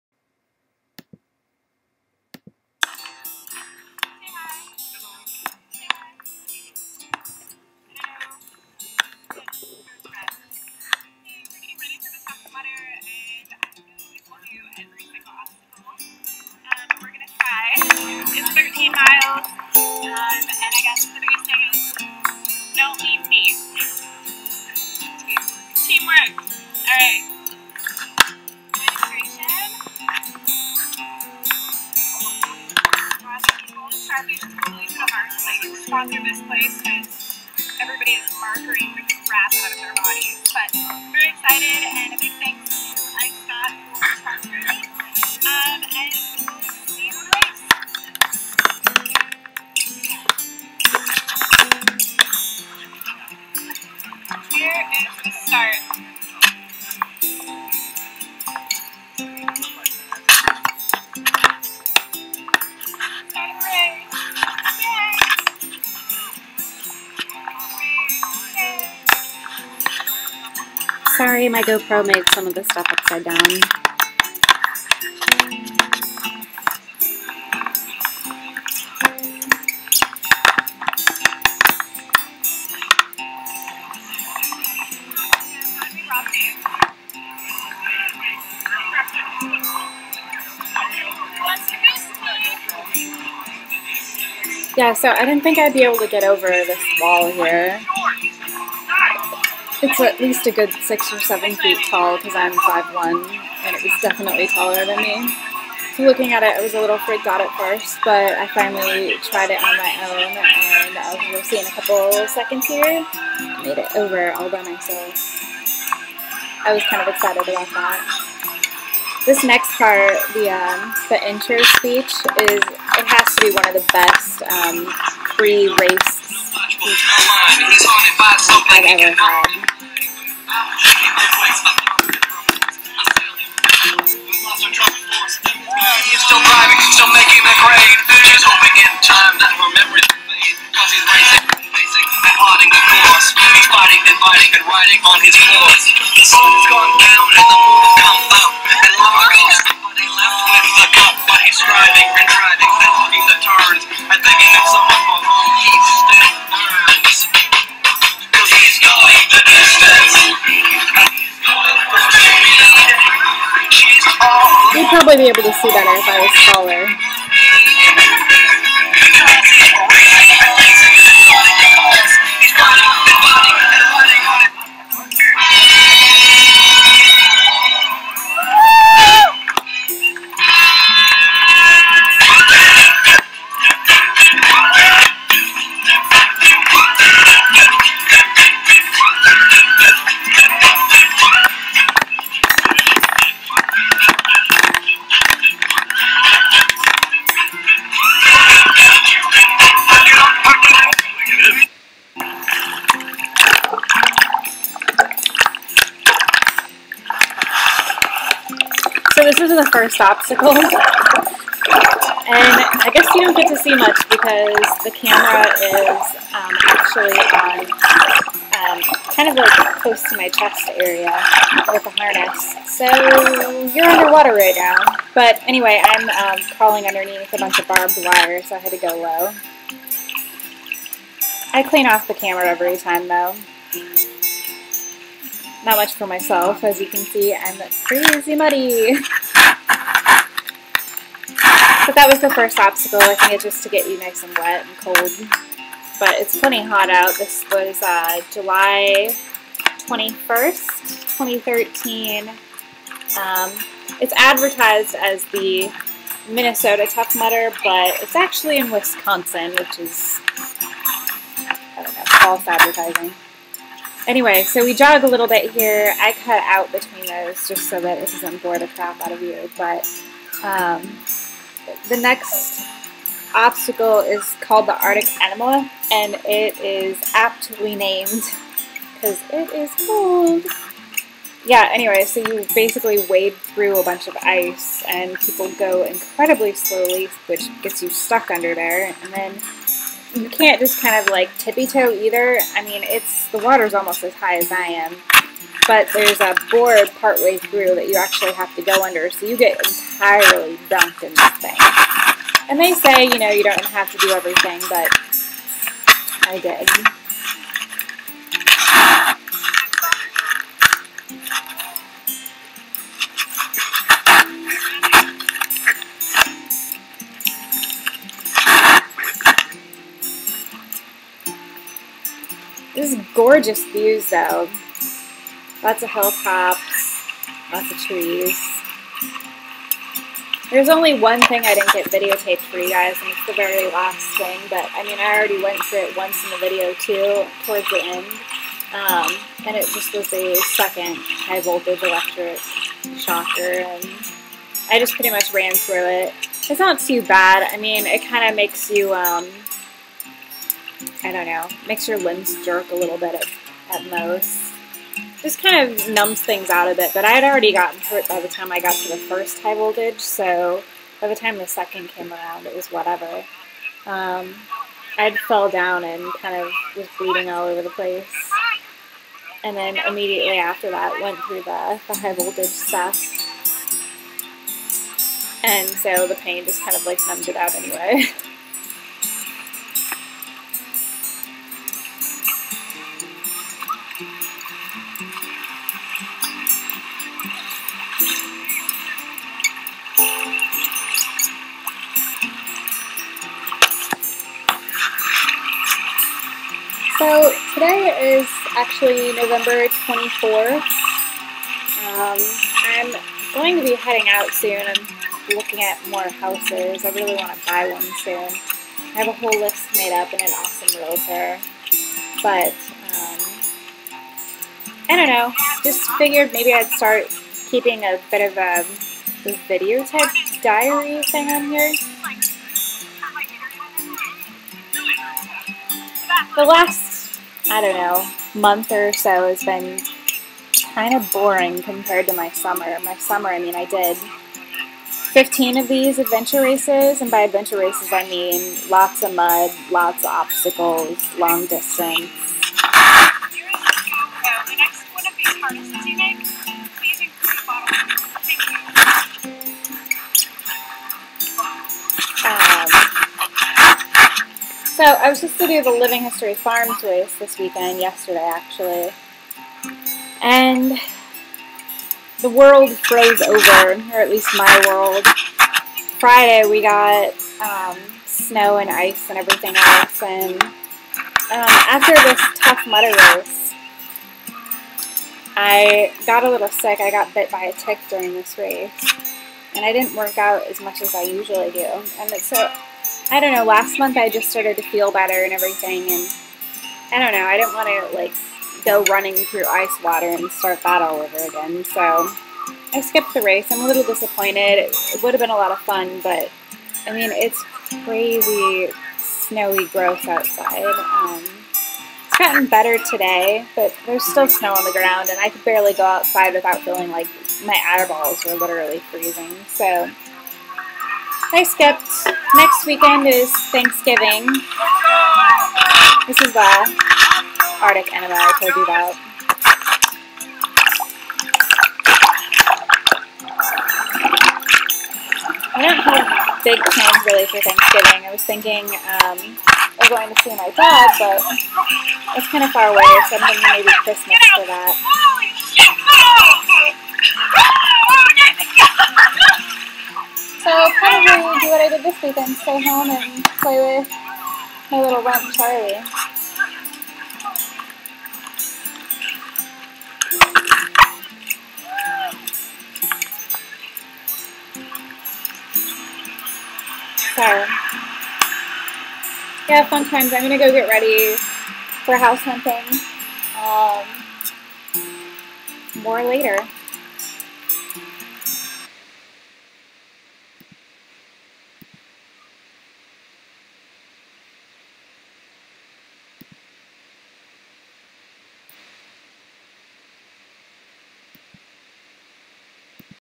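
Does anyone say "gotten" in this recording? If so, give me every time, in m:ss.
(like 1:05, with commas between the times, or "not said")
5:57, 8:22.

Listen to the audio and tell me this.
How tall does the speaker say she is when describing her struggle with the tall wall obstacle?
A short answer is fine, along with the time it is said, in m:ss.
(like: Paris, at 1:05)
5'1", at 1:42.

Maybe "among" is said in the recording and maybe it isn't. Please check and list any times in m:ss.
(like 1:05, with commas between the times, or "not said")
not said.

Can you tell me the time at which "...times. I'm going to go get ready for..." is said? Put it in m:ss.
9:19.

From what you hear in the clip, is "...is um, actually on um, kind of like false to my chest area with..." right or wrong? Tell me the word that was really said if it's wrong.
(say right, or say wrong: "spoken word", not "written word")
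wrong: "close", not "false".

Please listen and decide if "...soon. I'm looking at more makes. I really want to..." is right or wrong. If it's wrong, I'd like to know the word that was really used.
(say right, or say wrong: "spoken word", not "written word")
wrong: "houses", not "makes".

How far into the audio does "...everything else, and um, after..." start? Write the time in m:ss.
7:49.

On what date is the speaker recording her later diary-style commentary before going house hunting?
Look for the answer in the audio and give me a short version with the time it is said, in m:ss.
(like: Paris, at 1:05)
November 24th, at 6:39.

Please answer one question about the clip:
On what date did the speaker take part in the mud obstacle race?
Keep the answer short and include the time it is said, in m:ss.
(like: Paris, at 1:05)
July 21st, 2013, at 4:08.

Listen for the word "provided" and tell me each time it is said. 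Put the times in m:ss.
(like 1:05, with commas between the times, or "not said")
not said.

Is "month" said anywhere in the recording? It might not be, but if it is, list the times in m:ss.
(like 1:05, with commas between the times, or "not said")
7:08, 8:03.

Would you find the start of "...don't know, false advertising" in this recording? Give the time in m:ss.
4:21.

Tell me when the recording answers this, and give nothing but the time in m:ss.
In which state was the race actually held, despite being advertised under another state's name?
4:18.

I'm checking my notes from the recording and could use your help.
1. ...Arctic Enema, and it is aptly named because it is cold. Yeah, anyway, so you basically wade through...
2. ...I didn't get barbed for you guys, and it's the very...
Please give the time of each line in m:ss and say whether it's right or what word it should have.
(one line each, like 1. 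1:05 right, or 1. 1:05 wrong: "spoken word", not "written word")
1. 4:34 right
2. 5:31 wrong: "videotaped", not "barbed".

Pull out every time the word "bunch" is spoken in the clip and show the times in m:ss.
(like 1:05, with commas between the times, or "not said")
3:47, 4:43.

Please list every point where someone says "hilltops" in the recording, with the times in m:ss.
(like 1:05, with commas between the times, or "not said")
5:25.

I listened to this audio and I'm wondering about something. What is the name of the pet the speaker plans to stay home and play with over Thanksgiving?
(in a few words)
Charlie.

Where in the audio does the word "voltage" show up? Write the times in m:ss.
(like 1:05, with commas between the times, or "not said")
5:41, 5:59, 6:12.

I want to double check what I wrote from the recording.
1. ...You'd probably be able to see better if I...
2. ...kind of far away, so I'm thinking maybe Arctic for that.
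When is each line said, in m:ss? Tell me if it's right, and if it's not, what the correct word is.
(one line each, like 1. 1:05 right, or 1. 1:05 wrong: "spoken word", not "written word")
1. 2:44 right
2. 8:52 wrong: "Christmas", not "Arctic".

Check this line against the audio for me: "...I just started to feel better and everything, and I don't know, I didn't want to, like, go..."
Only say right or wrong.
right.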